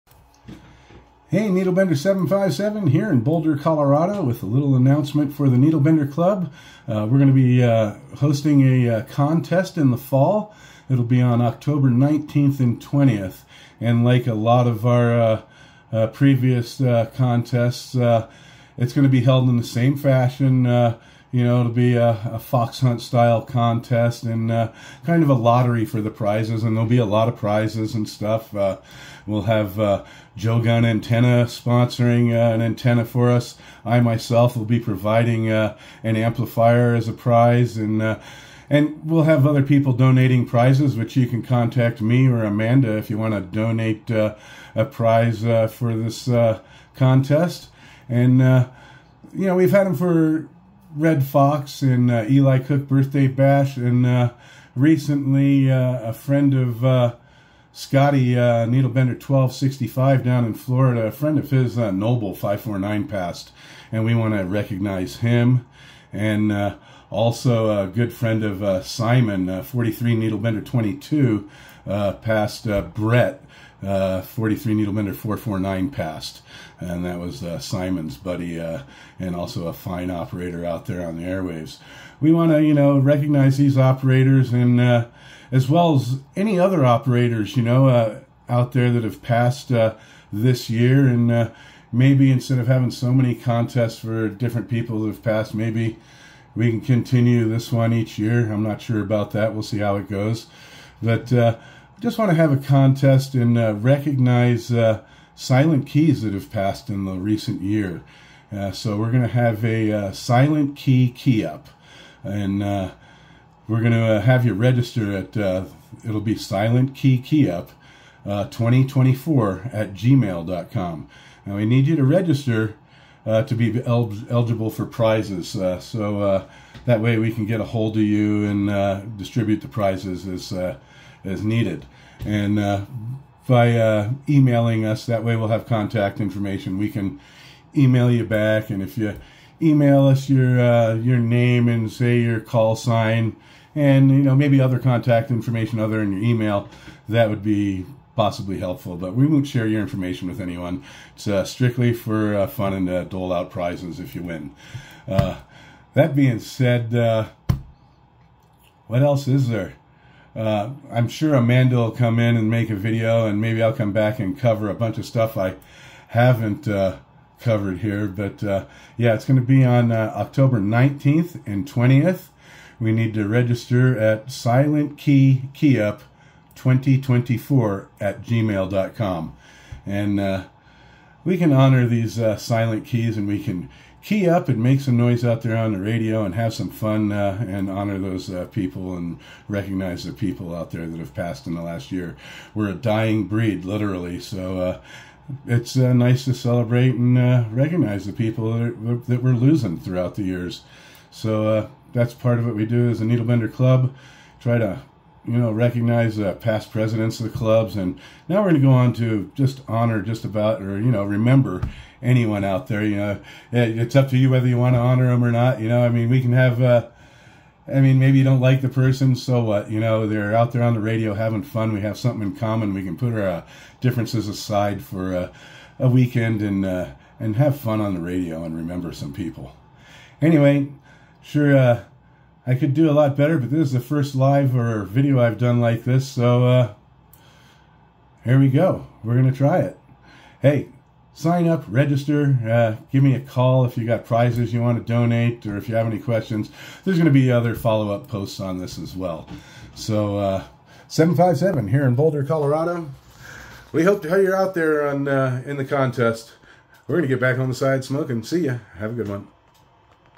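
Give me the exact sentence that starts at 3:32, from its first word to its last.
You know, it's up to you whether you want to honor them or not.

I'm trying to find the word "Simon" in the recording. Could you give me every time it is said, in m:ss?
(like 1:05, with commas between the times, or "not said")
1:08, 1:17.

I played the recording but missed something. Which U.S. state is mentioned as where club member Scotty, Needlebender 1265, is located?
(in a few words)
Florida.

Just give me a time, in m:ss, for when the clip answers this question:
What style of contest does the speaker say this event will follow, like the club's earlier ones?
0:22.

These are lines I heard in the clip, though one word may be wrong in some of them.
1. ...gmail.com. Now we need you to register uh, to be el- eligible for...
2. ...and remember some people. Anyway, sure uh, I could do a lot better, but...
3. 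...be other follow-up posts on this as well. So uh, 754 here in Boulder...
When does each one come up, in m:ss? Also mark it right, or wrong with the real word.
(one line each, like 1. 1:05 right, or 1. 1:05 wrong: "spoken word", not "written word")
1. 1:59 right
2. 3:48 right
3. 4:07 wrong: "757", not "754".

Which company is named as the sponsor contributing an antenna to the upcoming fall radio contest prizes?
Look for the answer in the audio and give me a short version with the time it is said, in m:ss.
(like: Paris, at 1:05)
Jo Gunn Antenna, at 0:30.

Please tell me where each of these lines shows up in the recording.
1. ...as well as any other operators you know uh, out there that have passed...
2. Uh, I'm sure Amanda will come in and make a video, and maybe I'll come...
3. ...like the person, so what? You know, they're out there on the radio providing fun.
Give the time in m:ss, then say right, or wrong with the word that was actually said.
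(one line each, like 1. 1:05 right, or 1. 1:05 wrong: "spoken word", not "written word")
1. 1:25 right
2. 2:40 right
3. 3:38 wrong: "having", not "providing".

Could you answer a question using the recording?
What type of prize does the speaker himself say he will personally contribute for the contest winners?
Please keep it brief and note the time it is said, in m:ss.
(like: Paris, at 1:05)
an amplifier, at 0:36.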